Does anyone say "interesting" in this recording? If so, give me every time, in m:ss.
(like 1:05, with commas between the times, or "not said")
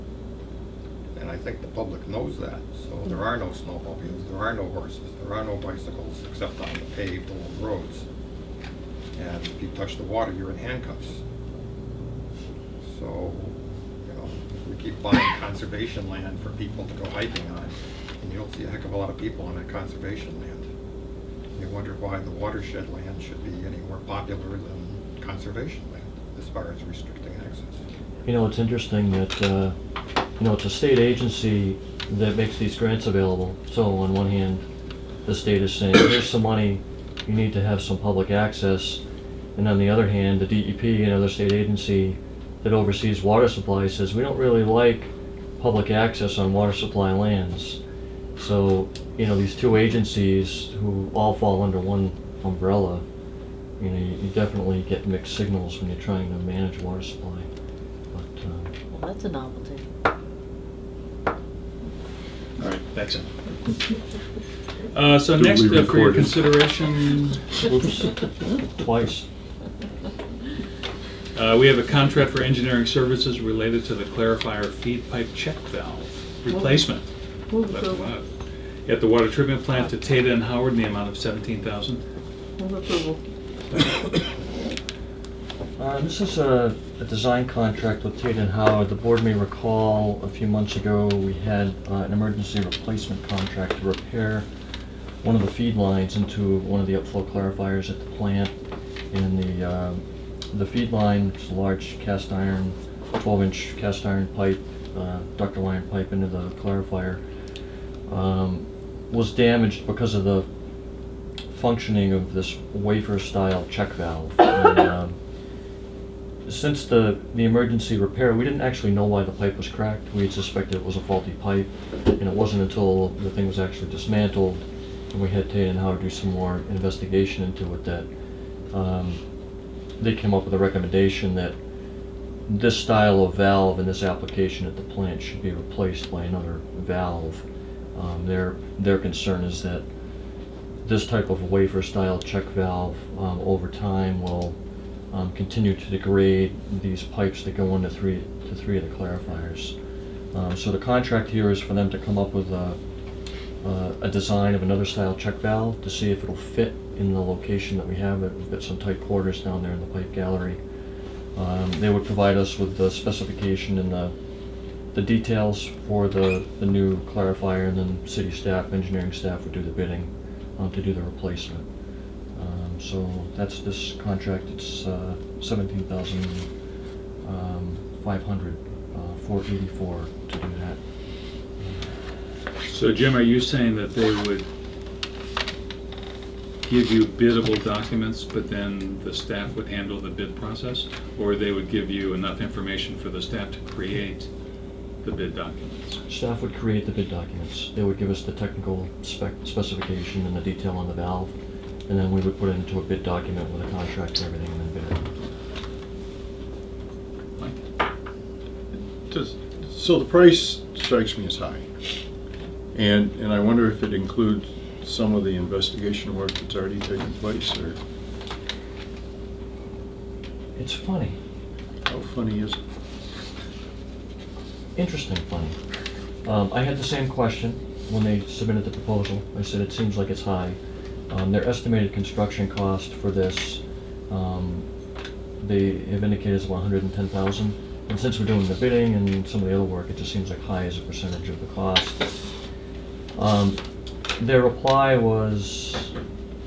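0:28, 3:44.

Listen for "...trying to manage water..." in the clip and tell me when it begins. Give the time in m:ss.
0:56.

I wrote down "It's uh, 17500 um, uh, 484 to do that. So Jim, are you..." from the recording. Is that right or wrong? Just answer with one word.
right.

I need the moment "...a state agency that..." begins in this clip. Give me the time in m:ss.
0:30.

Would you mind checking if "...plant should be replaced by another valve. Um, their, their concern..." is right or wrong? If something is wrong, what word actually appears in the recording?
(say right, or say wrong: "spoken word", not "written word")
right.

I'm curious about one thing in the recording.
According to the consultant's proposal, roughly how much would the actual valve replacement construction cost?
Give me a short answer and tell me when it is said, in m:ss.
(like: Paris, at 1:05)
110,000, at 3:56.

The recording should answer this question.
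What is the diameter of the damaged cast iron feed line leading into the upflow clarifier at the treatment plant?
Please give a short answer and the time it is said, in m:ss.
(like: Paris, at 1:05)
12 inch, at 1:43.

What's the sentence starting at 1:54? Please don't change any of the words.
And, um, since the, the emergency repair, we didn't actually know why the pipe was cracked.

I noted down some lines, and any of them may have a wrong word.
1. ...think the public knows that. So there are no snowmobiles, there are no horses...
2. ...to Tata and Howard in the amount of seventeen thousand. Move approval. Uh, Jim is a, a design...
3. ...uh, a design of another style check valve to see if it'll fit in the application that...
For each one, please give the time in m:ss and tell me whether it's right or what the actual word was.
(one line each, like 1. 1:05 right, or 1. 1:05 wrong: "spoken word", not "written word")
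1. 0:01 right
2. 1:19 wrong: "This", not "Jim"
3. 2:33 wrong: "location", not "application".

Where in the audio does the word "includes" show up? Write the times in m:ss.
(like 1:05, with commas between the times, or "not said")
3:33.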